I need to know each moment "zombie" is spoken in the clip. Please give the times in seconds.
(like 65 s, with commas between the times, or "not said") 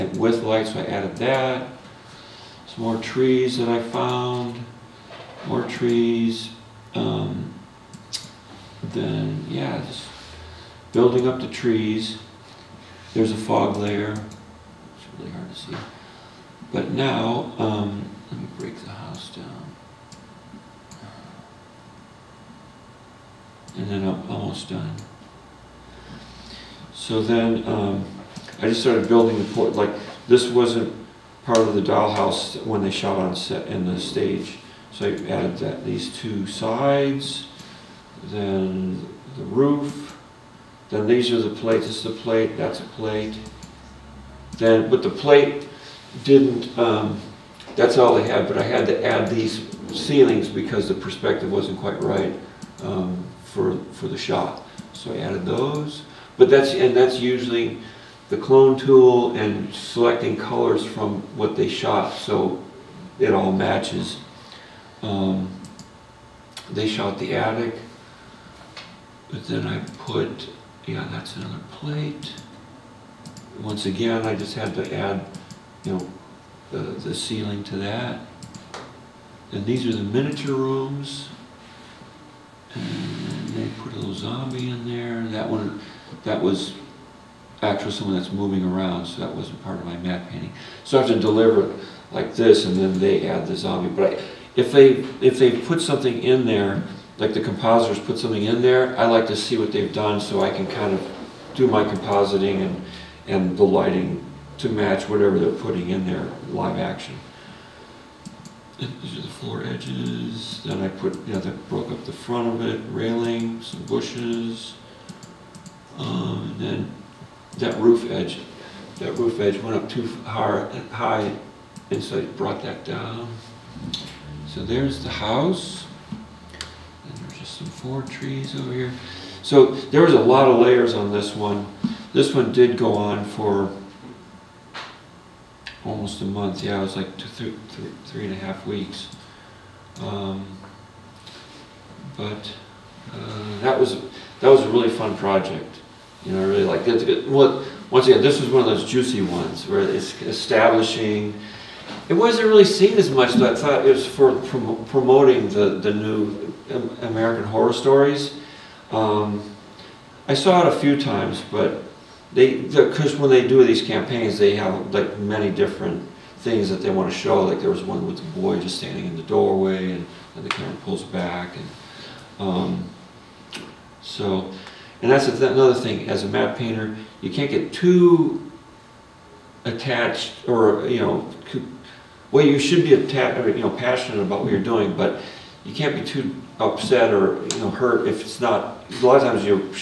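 84 s, 93 s.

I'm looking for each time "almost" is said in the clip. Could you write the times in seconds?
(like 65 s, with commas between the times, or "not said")
24 s, 135 s.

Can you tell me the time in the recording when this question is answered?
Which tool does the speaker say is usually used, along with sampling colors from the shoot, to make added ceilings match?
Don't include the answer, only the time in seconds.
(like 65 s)
58 s.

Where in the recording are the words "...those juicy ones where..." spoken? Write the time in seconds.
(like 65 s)
148 s.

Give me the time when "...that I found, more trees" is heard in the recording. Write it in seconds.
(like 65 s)
3 s.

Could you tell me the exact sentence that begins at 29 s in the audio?
Like this wasn't part of the dollhouse when they shot on set in the stage.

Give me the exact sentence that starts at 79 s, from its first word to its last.
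And these are the miniature rooms.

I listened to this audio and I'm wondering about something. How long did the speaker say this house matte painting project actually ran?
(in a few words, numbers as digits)
3.5 weeks.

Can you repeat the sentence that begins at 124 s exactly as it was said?
So there's the house some four trees over here.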